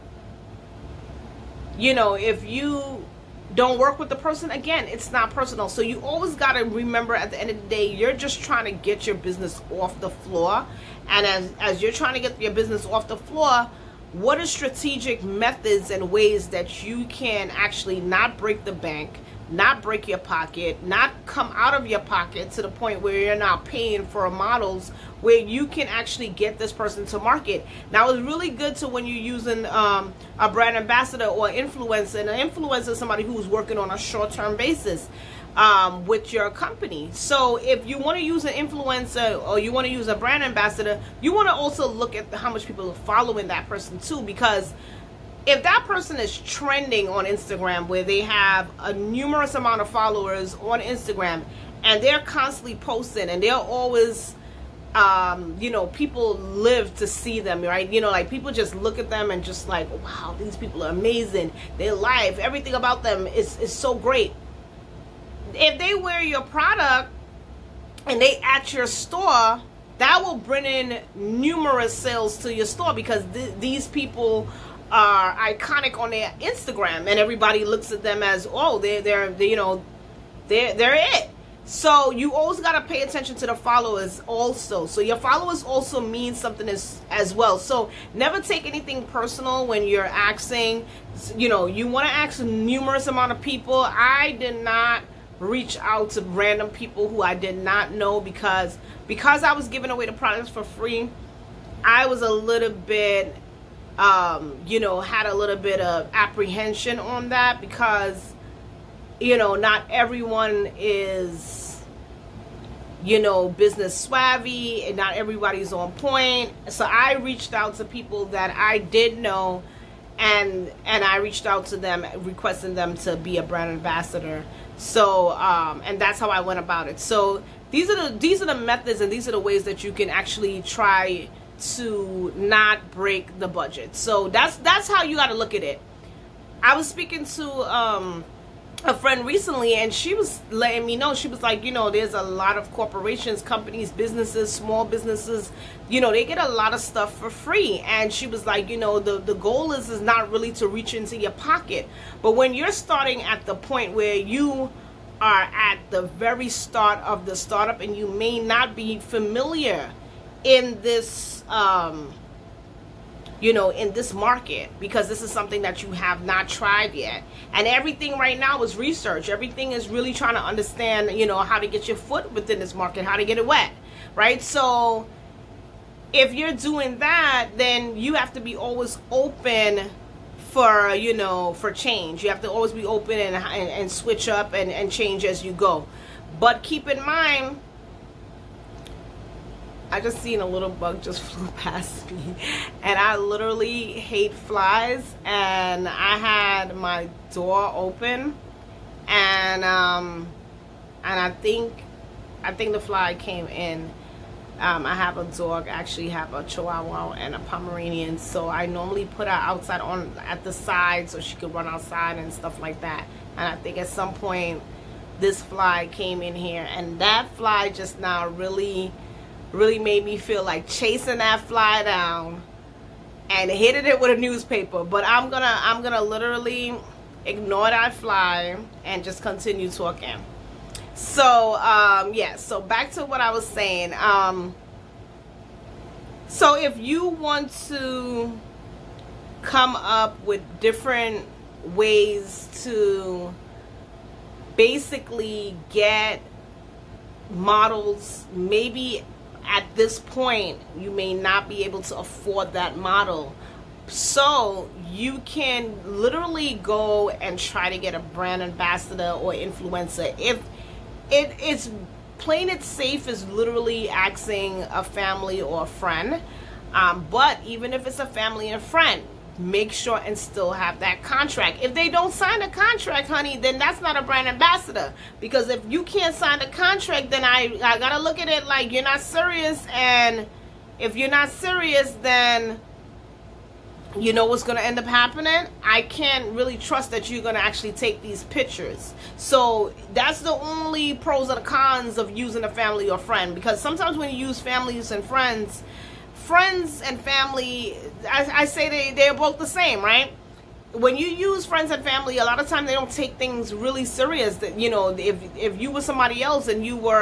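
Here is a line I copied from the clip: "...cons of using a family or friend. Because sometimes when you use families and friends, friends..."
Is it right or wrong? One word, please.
right.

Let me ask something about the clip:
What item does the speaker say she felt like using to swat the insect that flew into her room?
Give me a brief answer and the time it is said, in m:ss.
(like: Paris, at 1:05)
A newspaper, at 3:44.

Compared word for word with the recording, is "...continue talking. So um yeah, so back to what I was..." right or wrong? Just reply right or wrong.
right.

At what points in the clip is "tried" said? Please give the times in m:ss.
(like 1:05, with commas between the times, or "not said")
2:46.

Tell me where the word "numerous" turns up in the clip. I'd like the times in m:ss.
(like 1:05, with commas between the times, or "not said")
0:48, 1:11, 1:32.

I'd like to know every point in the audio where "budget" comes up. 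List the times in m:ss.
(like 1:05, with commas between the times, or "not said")
2:13.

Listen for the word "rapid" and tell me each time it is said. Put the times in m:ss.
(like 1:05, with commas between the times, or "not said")
not said.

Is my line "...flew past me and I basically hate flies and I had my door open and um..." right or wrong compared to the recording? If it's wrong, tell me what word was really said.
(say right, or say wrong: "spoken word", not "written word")
wrong: "literally", not "basically".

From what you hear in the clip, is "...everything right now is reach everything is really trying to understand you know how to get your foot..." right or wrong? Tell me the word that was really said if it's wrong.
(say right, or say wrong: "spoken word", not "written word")
wrong: "research", not "reach".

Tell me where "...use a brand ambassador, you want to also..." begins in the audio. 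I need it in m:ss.
0:39.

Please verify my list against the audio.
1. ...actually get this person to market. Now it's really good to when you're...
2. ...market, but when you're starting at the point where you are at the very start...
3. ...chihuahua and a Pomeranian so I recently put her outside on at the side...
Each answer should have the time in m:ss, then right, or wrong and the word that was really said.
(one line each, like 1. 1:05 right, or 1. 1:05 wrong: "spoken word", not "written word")
1. 0:25 right
2. 2:31 wrong: "pocket", not "market"
3. 3:26 wrong: "normally", not "recently".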